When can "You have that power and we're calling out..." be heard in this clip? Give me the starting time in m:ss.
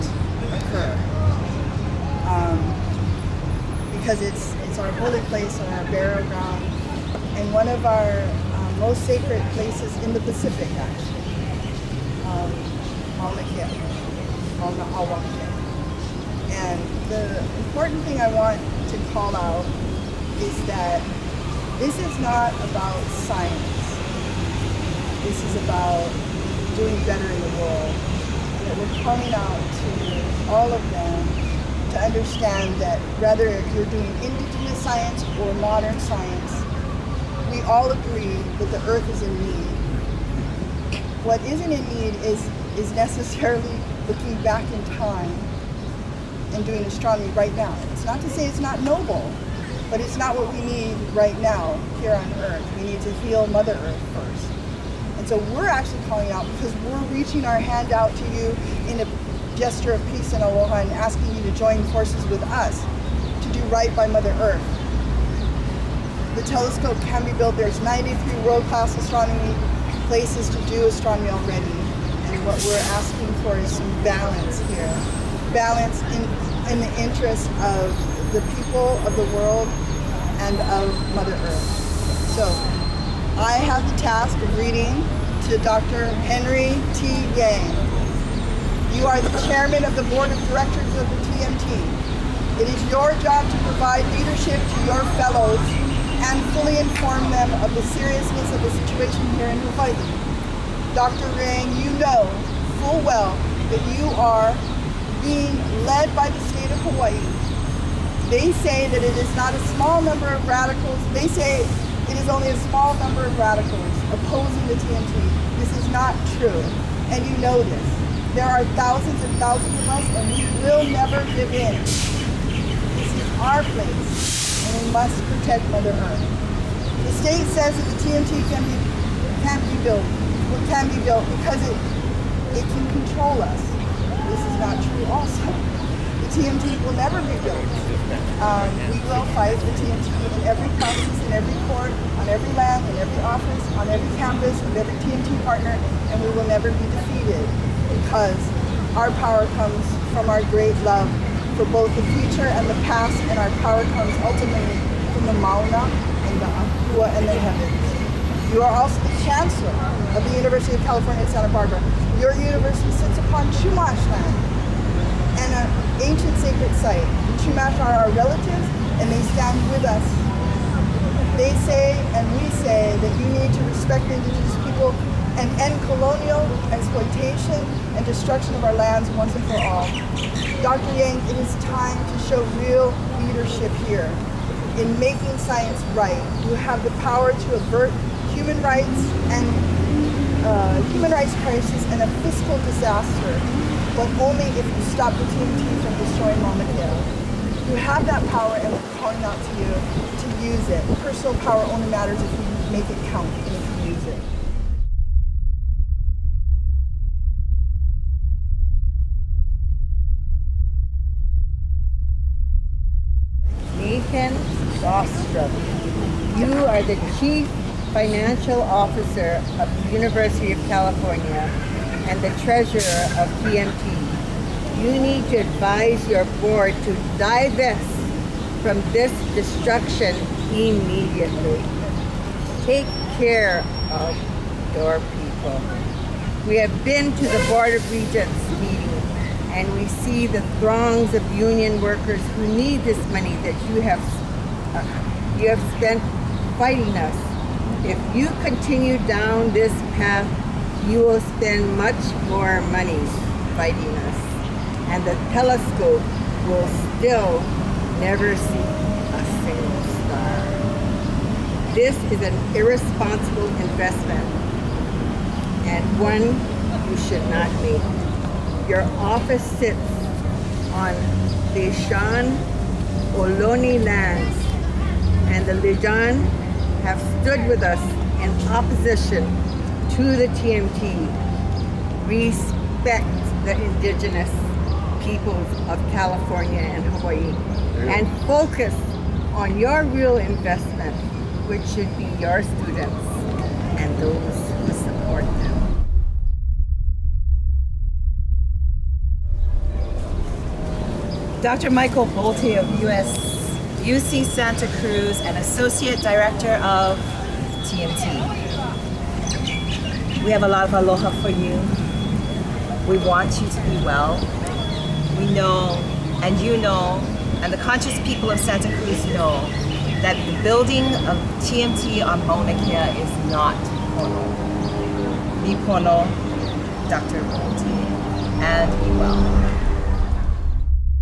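3:17.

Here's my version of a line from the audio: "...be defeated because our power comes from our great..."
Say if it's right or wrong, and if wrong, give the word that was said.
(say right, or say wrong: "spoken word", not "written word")
right.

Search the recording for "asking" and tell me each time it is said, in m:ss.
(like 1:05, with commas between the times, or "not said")
1:00, 1:12.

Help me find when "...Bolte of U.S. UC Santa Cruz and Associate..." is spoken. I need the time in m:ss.
5:02.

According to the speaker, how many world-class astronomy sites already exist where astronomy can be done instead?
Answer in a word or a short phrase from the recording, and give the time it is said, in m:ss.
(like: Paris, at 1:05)
93, at 1:07.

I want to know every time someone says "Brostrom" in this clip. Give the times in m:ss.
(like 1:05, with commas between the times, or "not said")
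3:34.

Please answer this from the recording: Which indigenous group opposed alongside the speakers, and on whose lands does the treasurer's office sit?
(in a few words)
Lisjan.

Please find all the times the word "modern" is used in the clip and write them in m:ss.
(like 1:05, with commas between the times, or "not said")
0:35.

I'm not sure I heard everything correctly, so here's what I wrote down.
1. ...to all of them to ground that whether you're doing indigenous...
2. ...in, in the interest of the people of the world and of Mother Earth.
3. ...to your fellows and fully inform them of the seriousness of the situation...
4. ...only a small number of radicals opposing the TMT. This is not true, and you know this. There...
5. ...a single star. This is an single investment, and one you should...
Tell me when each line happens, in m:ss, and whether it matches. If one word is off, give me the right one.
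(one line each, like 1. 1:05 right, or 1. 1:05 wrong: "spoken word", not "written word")
1. 0:29 wrong: "understand", not "ground"
2. 1:16 right
3. 1:34 right
4. 1:52 right
5. 4:19 wrong: "irresponsible", not "single".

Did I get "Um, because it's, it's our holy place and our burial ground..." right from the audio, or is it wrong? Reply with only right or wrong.
right.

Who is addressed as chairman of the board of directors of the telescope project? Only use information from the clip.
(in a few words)
Dr. Henry T. Yang.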